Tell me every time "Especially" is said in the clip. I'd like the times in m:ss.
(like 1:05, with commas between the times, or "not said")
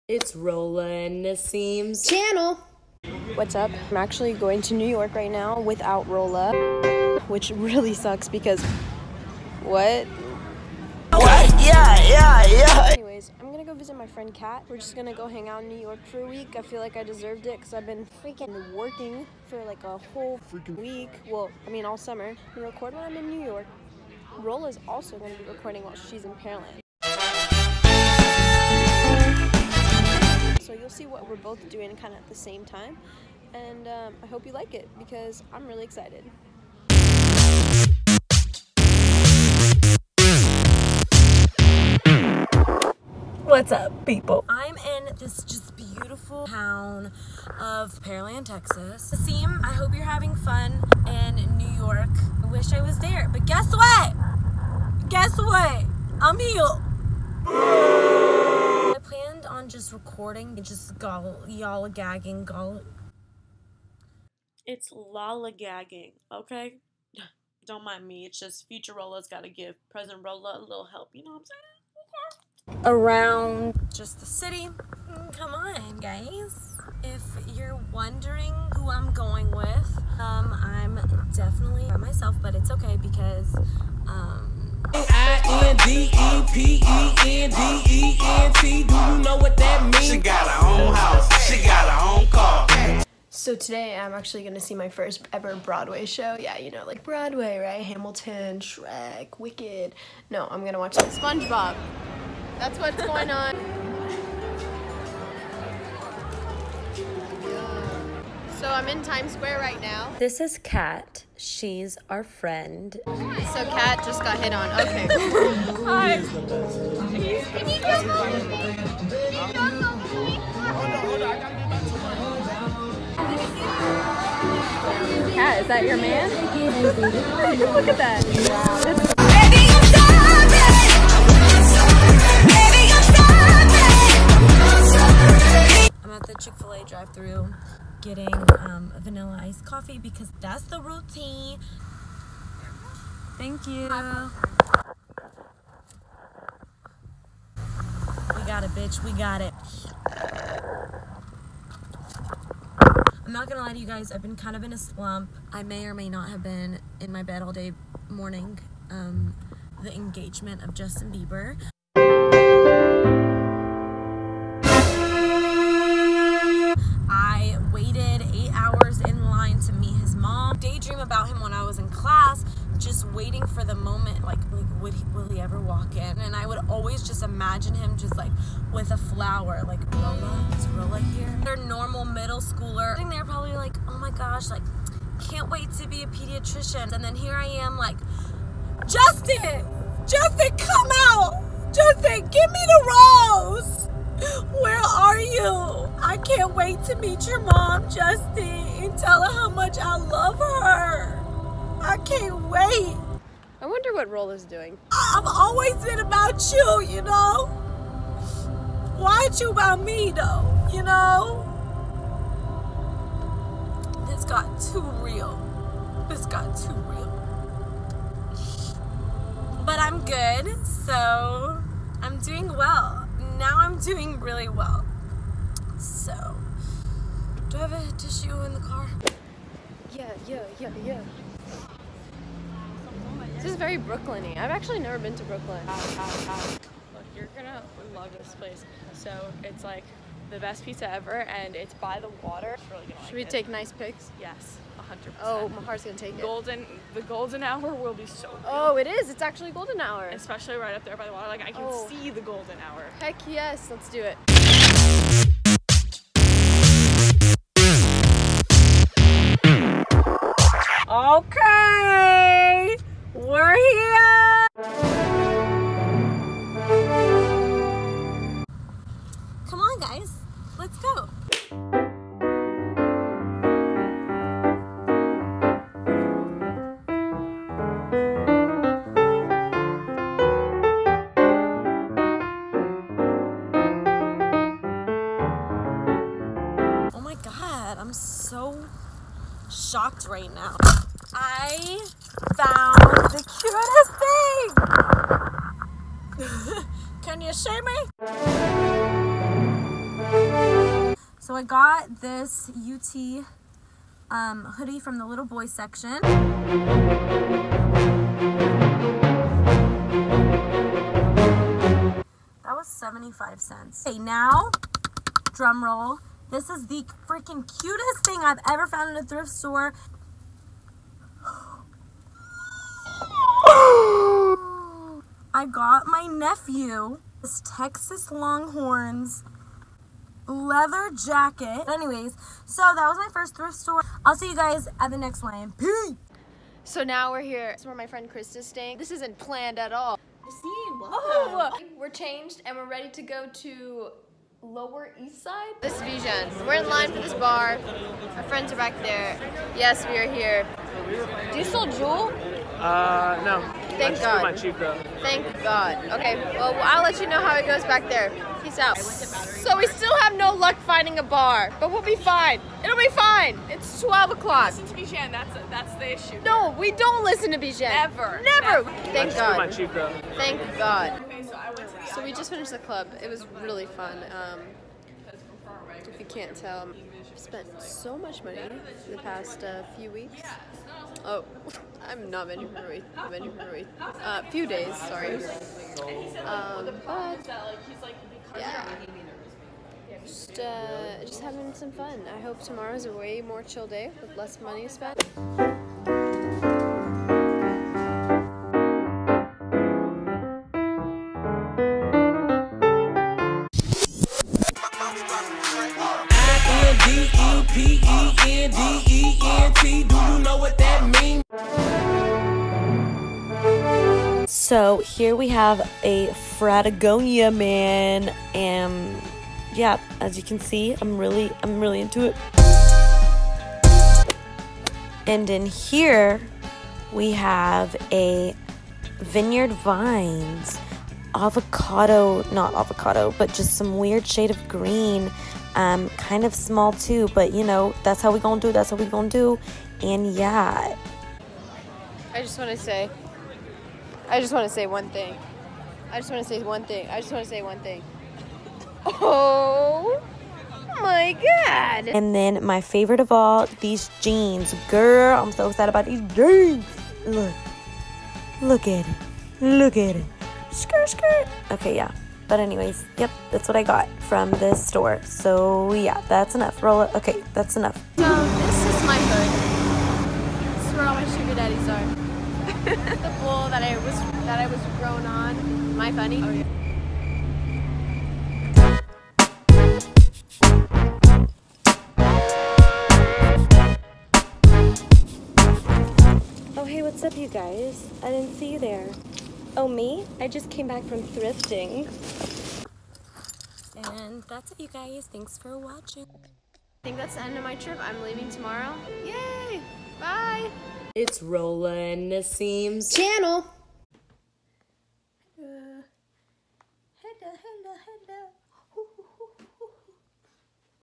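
4:10.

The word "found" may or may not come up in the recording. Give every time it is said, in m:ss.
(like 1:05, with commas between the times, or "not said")
4:52, 5:18.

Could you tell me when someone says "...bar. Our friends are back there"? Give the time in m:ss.
5:47.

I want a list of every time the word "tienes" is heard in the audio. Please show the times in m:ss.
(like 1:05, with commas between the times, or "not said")
not said.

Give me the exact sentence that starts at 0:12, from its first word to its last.
Anyways, I'm gonna go visit my friend Kat.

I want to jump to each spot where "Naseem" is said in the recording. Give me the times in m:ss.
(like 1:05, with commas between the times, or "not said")
0:01, 8:22.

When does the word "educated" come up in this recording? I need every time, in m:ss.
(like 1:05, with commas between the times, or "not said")
not said.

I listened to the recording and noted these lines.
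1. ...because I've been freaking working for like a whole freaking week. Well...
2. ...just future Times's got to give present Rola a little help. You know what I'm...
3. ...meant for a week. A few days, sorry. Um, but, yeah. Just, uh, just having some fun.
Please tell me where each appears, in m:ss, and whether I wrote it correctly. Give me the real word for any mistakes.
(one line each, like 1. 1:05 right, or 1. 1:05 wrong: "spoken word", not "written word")
1. 0:17 right
2. 1:08 wrong: "Rola", not "Times"
3. 6:22 right.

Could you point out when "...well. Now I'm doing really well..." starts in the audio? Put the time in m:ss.
3:42.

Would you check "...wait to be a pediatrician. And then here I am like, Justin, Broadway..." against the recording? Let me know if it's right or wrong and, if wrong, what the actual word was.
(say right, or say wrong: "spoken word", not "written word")
wrong: "Justin", not "Broadway".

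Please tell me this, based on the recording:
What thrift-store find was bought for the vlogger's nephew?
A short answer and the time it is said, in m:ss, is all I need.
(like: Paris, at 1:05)
Texas Longhorns leather jacket, at 5:27.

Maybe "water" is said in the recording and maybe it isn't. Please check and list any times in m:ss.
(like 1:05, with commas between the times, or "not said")
4:02, 4:11.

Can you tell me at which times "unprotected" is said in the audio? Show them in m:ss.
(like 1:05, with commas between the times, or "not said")
not said.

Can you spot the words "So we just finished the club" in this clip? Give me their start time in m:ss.
6:11.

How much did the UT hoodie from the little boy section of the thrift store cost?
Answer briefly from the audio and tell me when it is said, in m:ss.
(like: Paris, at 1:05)
75 cents, at 5:12.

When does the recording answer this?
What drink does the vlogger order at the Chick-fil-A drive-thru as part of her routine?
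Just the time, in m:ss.
2:18.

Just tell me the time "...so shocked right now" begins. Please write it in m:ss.
4:47.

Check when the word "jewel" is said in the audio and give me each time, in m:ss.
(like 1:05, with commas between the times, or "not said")
5:51.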